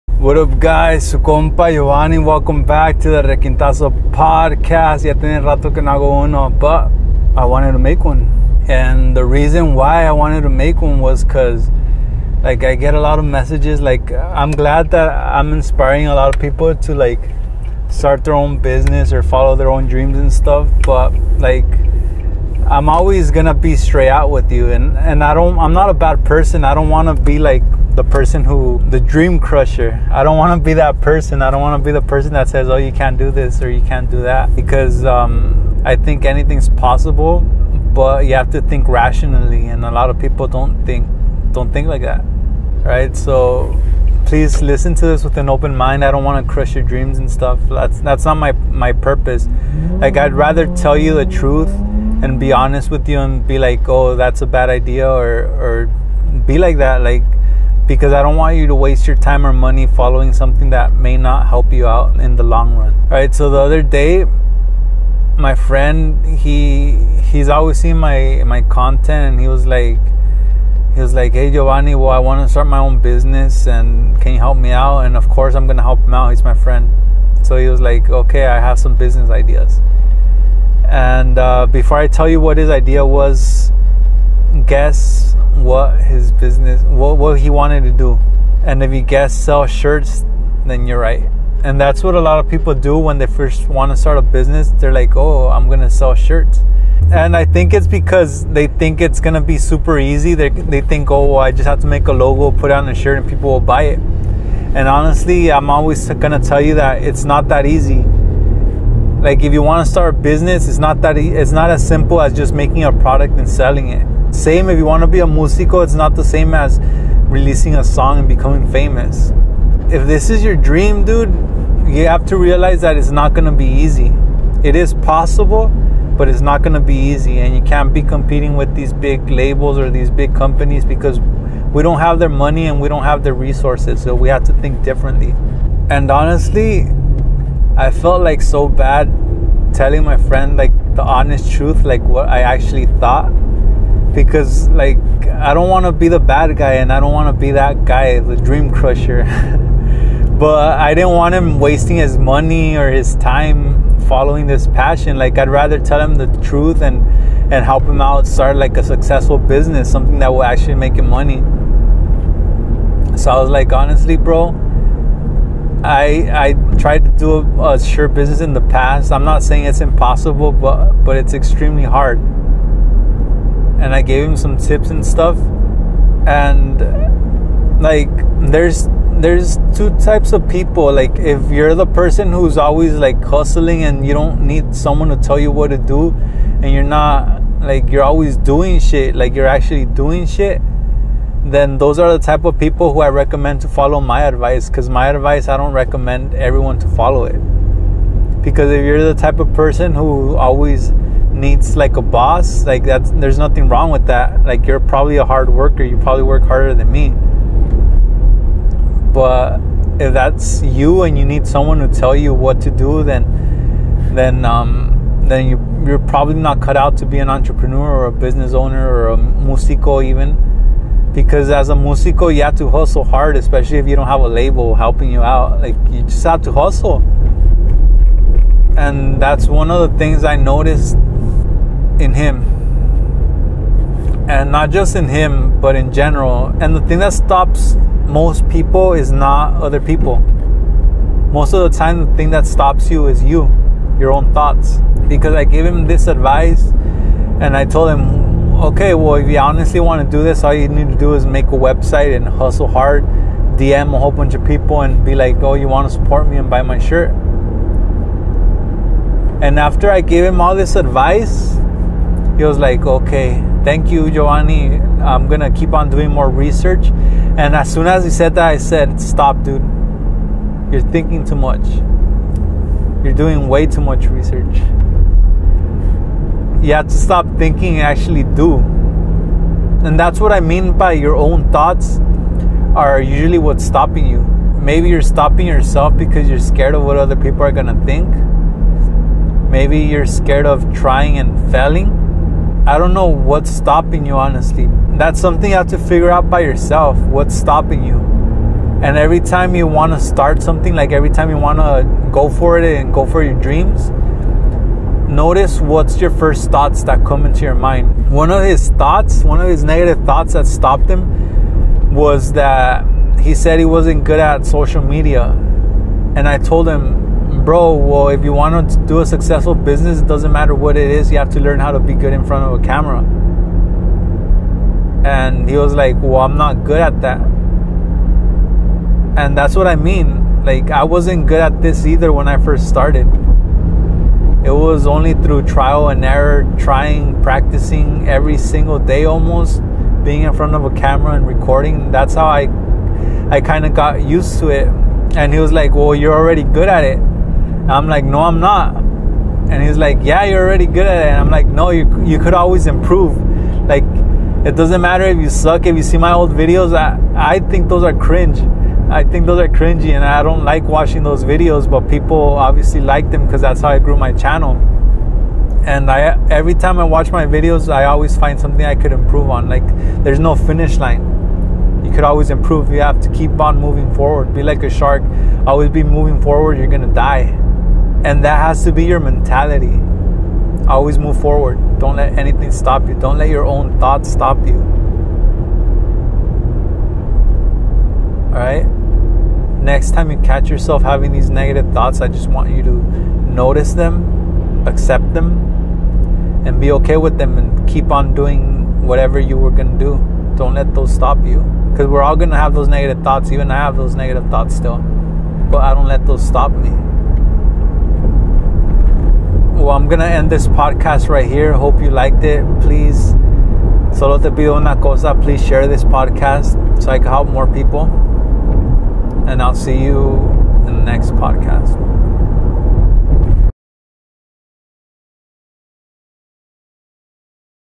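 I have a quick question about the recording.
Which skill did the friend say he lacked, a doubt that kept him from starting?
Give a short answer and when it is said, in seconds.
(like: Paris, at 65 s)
Social media, at 314 s.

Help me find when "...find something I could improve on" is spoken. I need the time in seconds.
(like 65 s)
368 s.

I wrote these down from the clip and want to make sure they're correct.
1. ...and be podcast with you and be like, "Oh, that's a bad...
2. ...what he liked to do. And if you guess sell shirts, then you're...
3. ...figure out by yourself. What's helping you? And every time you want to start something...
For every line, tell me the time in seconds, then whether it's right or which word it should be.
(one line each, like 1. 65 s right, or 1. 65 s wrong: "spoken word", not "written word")
1. 52 s wrong: "honest", not "podcast"
2. 87 s wrong: "wanted", not "liked"
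3. 295 s wrong: "stopping", not "helping".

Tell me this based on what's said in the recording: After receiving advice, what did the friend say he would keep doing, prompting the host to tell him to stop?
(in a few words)
More research.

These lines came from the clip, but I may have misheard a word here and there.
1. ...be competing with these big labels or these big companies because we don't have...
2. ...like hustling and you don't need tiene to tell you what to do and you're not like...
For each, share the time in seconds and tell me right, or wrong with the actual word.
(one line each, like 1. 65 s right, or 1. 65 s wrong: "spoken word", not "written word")
1. 127 s right
2. 182 s wrong: "someone", not "tiene".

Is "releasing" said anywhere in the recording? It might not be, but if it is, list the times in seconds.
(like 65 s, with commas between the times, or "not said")
117 s.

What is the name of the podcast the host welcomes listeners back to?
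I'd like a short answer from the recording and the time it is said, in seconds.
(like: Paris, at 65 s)
Requintazo podcast, at 3 s.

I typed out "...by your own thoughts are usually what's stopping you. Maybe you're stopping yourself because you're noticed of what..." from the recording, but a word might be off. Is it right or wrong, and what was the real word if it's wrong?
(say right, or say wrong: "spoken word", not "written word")
wrong: "scared", not "noticed".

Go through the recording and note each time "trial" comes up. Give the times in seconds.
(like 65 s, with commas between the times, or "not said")
335 s.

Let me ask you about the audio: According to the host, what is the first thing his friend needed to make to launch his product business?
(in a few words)
A website.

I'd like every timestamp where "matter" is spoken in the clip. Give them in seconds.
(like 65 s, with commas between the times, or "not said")
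320 s, 354 s.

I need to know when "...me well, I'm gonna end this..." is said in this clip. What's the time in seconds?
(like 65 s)
406 s.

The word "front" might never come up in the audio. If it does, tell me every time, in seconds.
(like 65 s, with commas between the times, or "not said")
322 s, 340 s.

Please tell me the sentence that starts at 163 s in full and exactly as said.
So I was like, honestly, bro, I I tried to do a, a sure business in the past.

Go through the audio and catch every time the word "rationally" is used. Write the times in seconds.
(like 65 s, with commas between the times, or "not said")
38 s.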